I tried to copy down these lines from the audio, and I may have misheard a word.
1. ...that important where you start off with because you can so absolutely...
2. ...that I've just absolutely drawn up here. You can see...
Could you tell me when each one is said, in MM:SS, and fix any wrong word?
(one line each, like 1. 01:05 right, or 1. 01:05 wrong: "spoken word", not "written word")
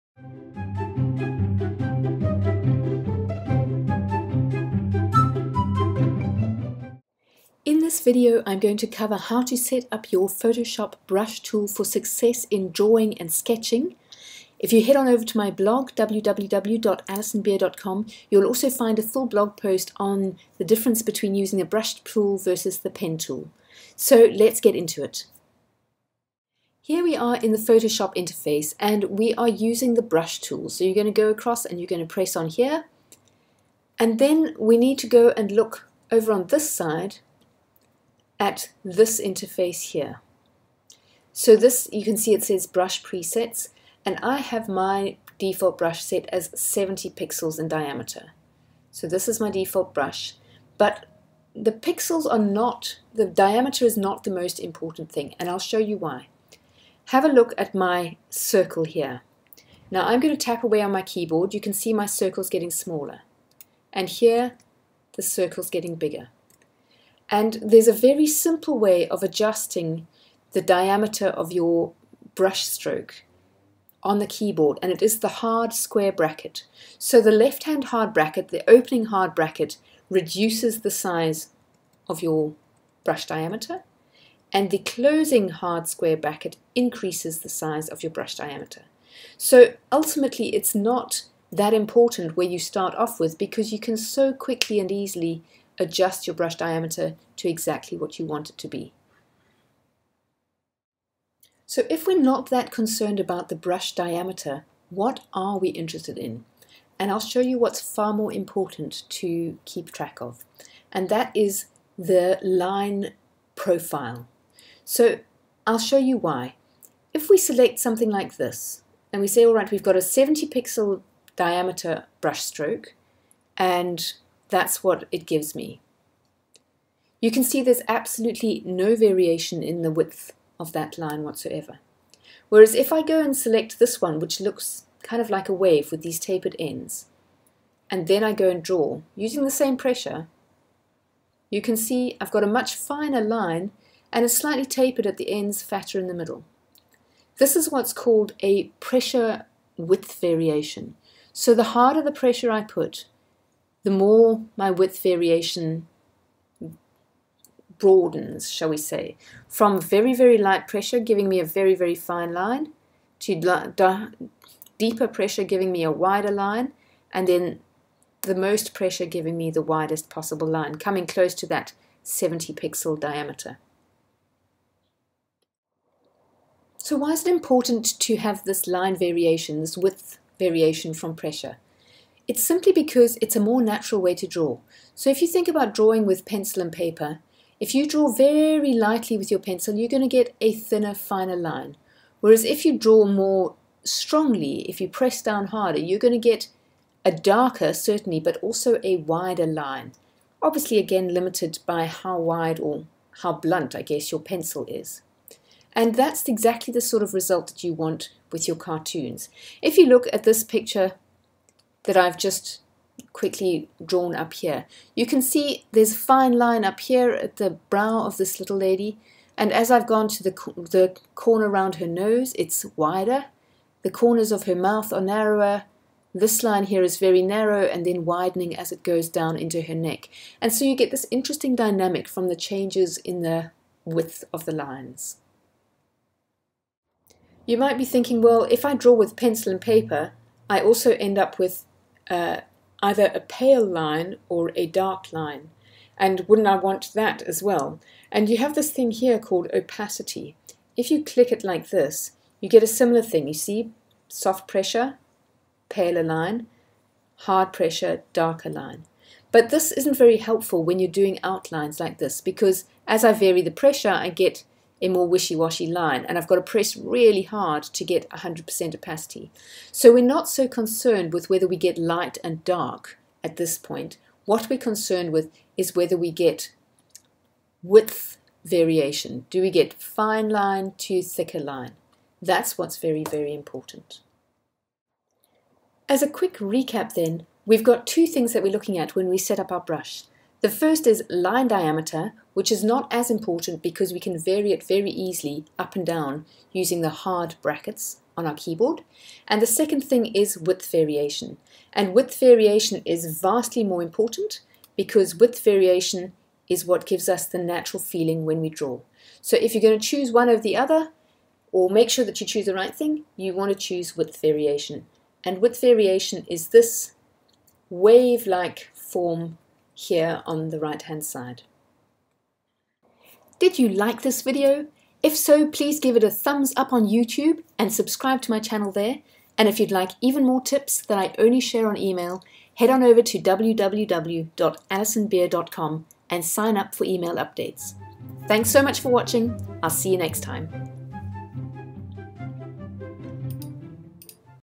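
1. 01:31 wrong: "quickly", not "absolutely"
2. 03:31 wrong: "quickly", not "absolutely".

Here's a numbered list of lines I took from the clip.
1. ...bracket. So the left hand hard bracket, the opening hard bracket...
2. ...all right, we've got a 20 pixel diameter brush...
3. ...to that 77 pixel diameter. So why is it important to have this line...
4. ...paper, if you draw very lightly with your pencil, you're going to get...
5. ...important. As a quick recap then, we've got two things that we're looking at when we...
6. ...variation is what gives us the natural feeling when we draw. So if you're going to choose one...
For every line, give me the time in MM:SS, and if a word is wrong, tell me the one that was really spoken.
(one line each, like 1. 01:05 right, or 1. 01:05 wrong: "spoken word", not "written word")
1. 01:16 right
2. 01:59 wrong: "70", not "20"
3. 02:51 wrong: "70", not "77"
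4. 03:06 right
5. 04:43 right
6. 05:05 right.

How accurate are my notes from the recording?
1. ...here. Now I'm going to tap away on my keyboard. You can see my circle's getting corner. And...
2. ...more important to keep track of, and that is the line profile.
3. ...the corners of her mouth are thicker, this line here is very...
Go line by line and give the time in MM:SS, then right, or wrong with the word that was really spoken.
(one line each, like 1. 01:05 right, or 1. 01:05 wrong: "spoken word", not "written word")
1. 00:58 wrong: "smaller", not "corner"
2. 01:48 right
3. 03:43 wrong: "narrower", not "thicker".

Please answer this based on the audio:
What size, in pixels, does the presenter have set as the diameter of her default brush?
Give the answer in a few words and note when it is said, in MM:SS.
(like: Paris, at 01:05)
70 pixels, at 00:46.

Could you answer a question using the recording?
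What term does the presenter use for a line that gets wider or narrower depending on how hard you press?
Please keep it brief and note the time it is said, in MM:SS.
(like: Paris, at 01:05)
Pressure width variation, at 02:28.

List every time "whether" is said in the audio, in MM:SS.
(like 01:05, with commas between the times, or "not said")
04:31, 04:35.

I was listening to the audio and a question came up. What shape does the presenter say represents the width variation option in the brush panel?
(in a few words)
Wave-like form.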